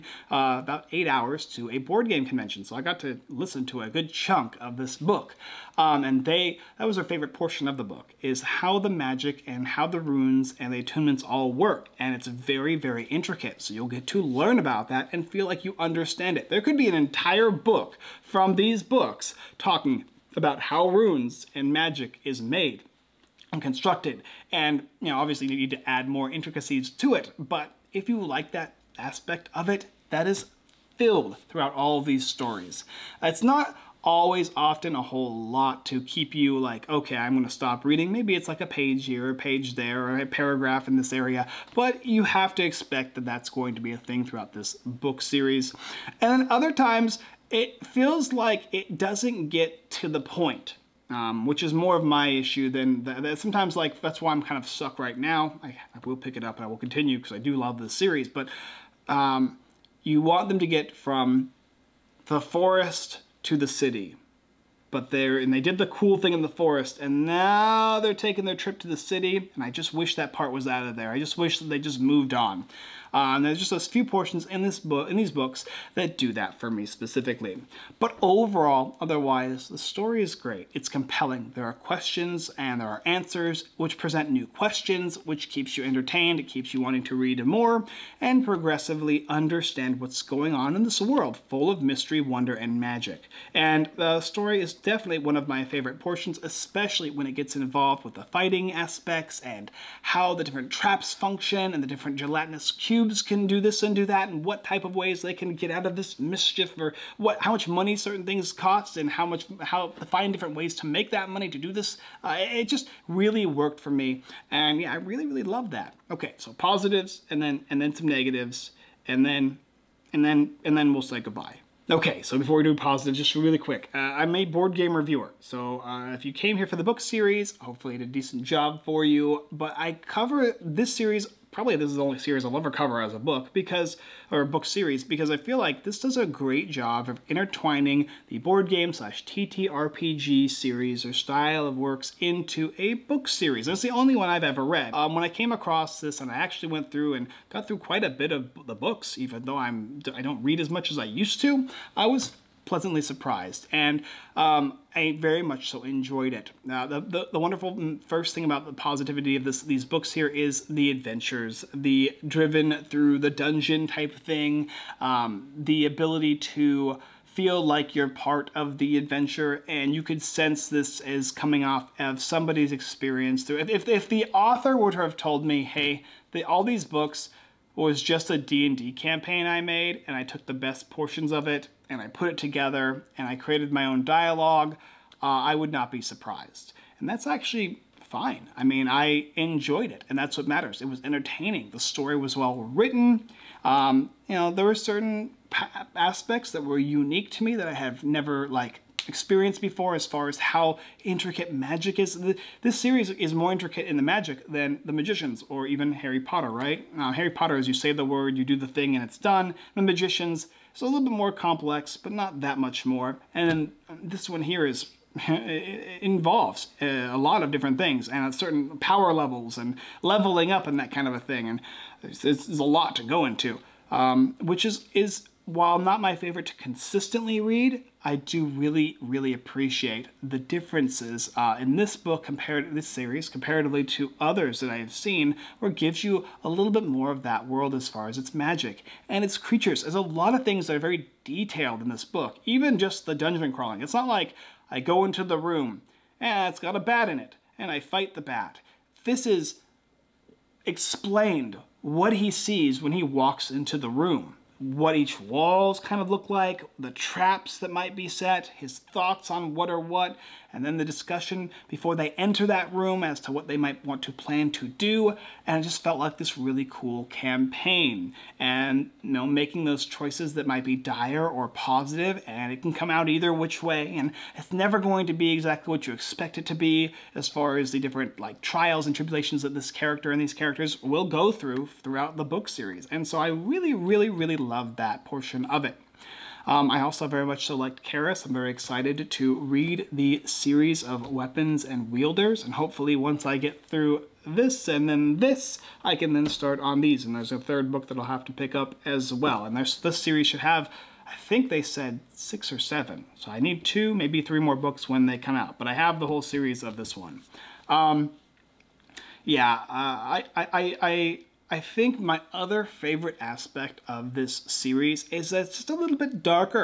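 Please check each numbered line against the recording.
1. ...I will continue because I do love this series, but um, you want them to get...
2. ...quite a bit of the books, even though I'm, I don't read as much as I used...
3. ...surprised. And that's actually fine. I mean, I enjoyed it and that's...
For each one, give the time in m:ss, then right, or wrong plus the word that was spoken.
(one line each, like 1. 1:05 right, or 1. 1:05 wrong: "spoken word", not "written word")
1. 0:56 right
2. 2:27 right
3. 3:05 right.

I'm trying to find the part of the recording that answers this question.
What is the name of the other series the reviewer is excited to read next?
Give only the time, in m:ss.
4:51.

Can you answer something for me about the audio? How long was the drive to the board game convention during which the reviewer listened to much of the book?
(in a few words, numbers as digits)
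8 hours.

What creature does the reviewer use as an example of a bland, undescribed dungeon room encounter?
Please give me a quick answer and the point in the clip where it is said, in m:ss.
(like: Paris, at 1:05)
a bat, at 4:06.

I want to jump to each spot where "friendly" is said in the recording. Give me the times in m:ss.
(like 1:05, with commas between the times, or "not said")
not said.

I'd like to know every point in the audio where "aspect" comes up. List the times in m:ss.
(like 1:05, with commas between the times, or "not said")
0:28, 1:38, 3:15, 5:13.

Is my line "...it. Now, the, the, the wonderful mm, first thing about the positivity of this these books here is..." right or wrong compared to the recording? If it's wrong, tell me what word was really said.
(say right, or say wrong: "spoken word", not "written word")
right.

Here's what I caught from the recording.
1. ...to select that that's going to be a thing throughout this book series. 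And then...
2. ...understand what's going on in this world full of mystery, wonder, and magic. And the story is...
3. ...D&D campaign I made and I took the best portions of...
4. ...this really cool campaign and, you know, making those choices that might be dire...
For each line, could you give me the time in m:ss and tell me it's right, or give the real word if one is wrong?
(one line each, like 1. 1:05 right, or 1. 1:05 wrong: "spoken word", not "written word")
1. 0:42 wrong: "expect", not "select"
2. 1:29 right
3. 2:58 right
4. 4:26 right.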